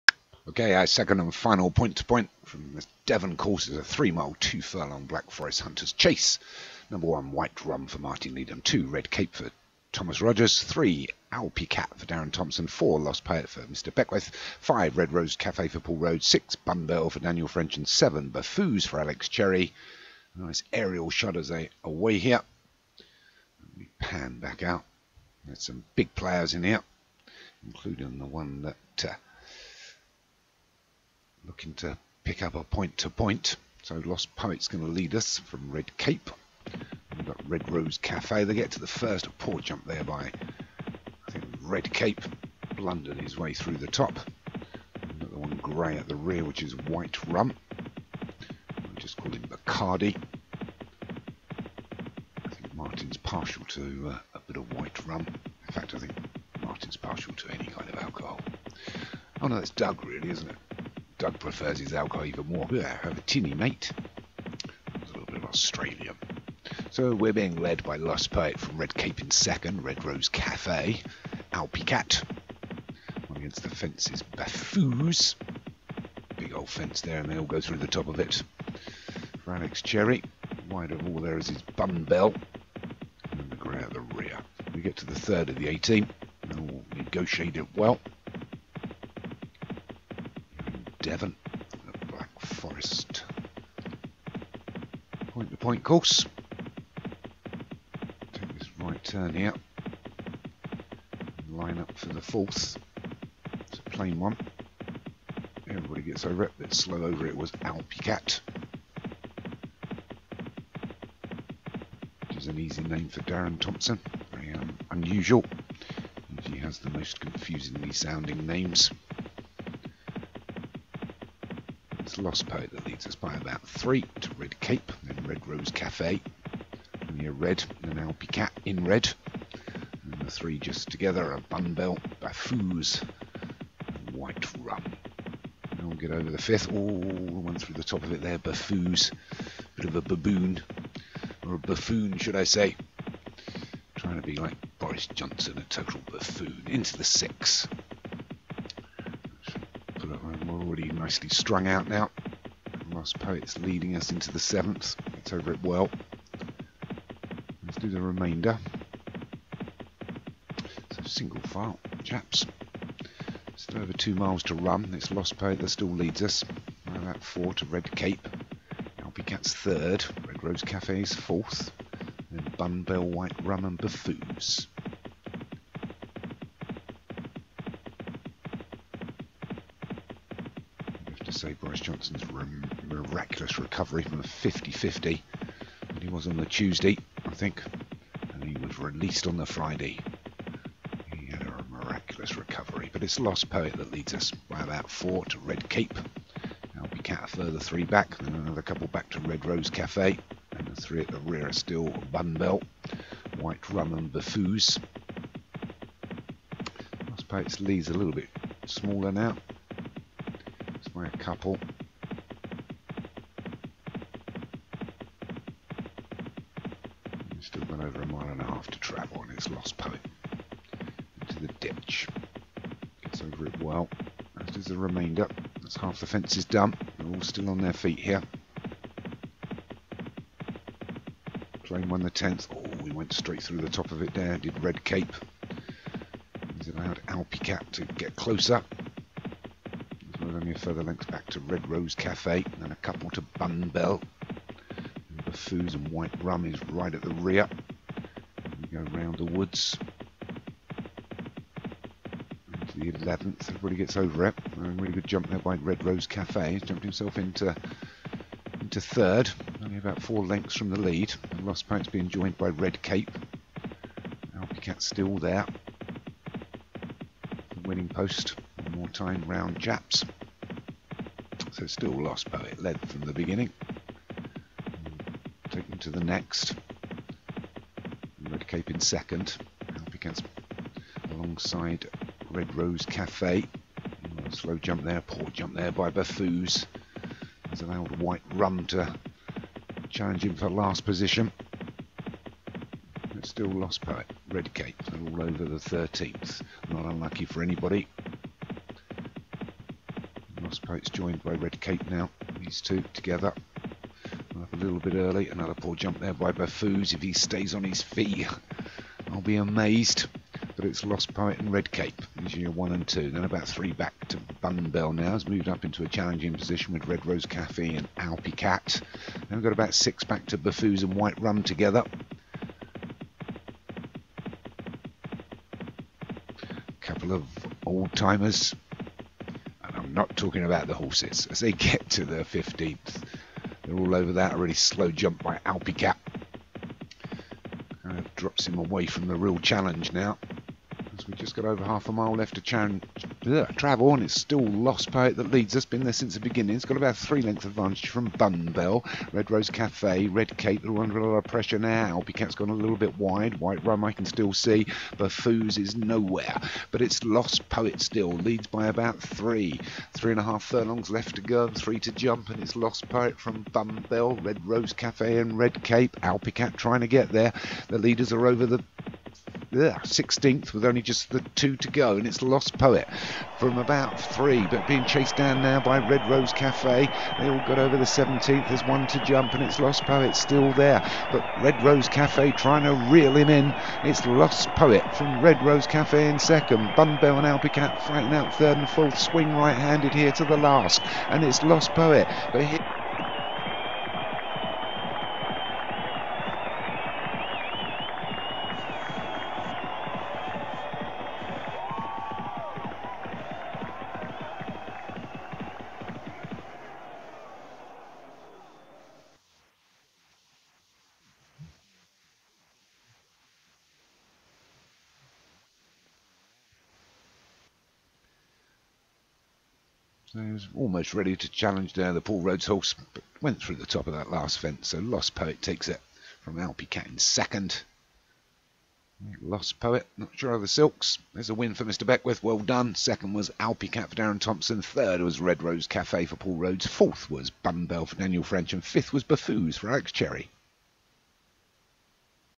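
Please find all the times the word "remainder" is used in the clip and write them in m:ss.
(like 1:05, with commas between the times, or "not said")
2:37, 3:44.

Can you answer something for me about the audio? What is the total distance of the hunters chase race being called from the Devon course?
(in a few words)
3 miles 2 furlongs.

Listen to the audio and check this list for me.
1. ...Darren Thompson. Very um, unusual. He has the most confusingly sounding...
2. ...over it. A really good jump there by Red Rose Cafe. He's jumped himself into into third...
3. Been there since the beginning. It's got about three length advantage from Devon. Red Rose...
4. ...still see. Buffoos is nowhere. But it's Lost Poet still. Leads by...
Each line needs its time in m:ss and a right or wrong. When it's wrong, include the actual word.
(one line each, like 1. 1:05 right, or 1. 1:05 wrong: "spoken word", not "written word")
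1. 1:53 right
2. 4:13 right
3. 5:45 wrong: "Bunbell", not "Devon"
4. 5:54 right.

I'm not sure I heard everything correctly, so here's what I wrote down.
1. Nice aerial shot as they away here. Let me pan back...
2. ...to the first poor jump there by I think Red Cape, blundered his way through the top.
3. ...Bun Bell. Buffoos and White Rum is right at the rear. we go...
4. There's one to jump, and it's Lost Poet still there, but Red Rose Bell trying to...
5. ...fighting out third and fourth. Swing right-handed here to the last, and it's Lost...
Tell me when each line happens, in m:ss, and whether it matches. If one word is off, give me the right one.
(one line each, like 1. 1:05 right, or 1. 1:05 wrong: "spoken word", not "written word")
1. 0:20 right
2. 0:38 right
3. 4:03 right
4. 6:18 wrong: "Cafe", not "Bell"
5. 6:27 right.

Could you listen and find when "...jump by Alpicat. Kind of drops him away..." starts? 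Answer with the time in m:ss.
5:34.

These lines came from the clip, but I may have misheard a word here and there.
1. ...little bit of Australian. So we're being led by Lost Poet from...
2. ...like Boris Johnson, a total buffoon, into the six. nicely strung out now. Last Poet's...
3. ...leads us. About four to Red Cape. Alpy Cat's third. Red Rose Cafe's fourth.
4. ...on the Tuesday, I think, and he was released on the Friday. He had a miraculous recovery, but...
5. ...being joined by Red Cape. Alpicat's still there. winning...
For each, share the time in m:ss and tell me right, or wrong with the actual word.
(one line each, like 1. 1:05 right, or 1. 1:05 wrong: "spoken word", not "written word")
1. 1:05 right
2. 2:24 right
3. 2:45 right
4. 3:06 right
5. 4:21 right.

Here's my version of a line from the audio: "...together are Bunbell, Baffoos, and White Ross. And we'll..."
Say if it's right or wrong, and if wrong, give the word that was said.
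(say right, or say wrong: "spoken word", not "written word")
wrong: "Rum", not "Ross".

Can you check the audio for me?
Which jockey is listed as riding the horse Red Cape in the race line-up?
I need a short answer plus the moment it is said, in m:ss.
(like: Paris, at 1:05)
Thomas Rogers, at 0:09.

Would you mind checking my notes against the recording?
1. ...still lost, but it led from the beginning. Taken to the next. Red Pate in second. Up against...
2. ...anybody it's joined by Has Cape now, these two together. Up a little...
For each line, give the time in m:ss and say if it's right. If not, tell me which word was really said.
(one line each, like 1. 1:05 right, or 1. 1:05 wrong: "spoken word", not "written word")
1. 4:31 wrong: "Cape", not "Pate"
2. 4:57 wrong: "Red", not "Has".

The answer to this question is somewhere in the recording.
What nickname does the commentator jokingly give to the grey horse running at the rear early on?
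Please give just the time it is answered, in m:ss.
0:49.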